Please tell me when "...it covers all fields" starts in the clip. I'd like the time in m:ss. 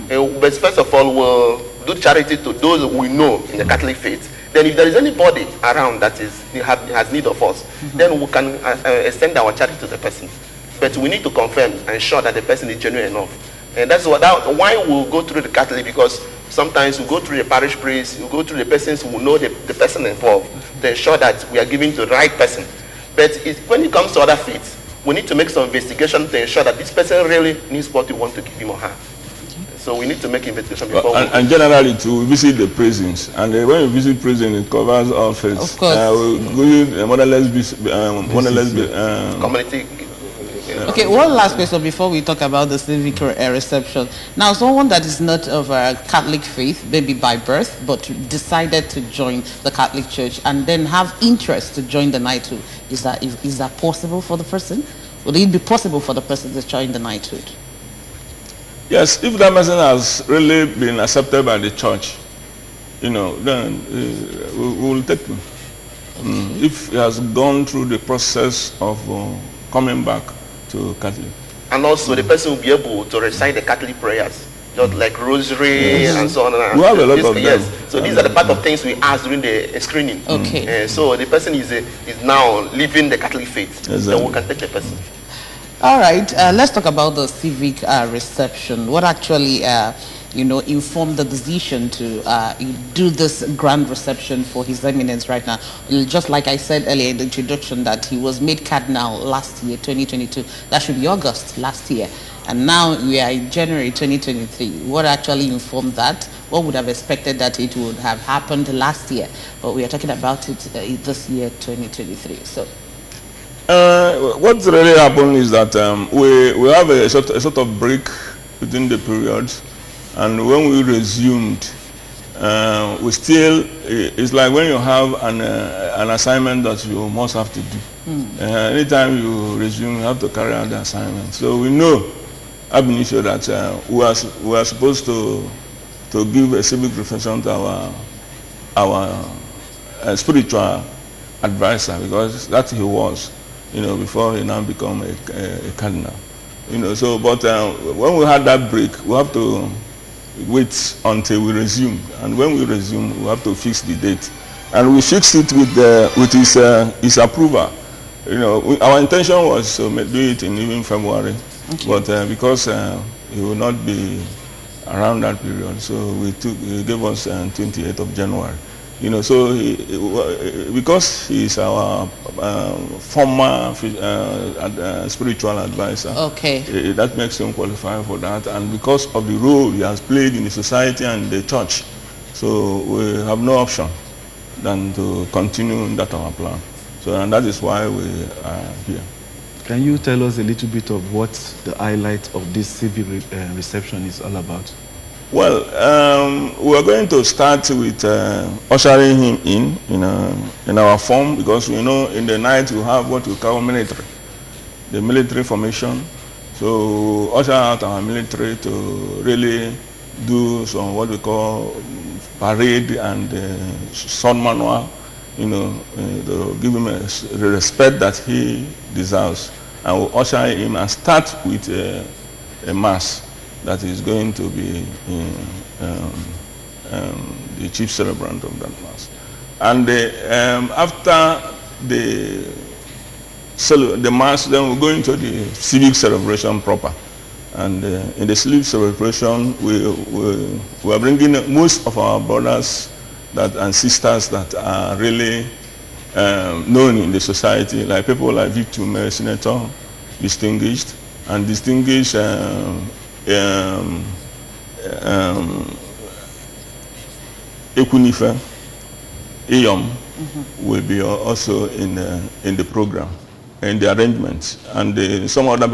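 0:34.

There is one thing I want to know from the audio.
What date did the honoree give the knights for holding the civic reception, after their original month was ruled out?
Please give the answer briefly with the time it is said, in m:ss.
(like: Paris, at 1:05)
28 January, at 2:47.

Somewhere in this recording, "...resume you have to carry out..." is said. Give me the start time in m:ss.
2:09.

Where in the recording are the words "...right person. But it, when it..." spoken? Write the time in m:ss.
0:22.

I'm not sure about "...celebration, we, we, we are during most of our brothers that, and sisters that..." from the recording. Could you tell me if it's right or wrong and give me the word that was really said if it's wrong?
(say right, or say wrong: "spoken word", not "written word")
wrong: "bringing", not "during".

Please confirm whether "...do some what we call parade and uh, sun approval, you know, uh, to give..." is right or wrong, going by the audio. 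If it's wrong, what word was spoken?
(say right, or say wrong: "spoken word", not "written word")
wrong: "manual", not "approval".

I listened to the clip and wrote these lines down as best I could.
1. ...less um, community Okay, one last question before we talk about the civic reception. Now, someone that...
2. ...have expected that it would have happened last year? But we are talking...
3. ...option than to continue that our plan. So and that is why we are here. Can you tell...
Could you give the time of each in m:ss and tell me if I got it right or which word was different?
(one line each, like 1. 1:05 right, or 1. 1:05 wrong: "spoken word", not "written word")
1. 0:38 right
2. 1:46 right
3. 3:03 right.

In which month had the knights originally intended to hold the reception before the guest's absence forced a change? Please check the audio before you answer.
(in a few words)
February.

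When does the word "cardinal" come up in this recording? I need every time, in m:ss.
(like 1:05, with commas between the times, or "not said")
1:38, 2:25.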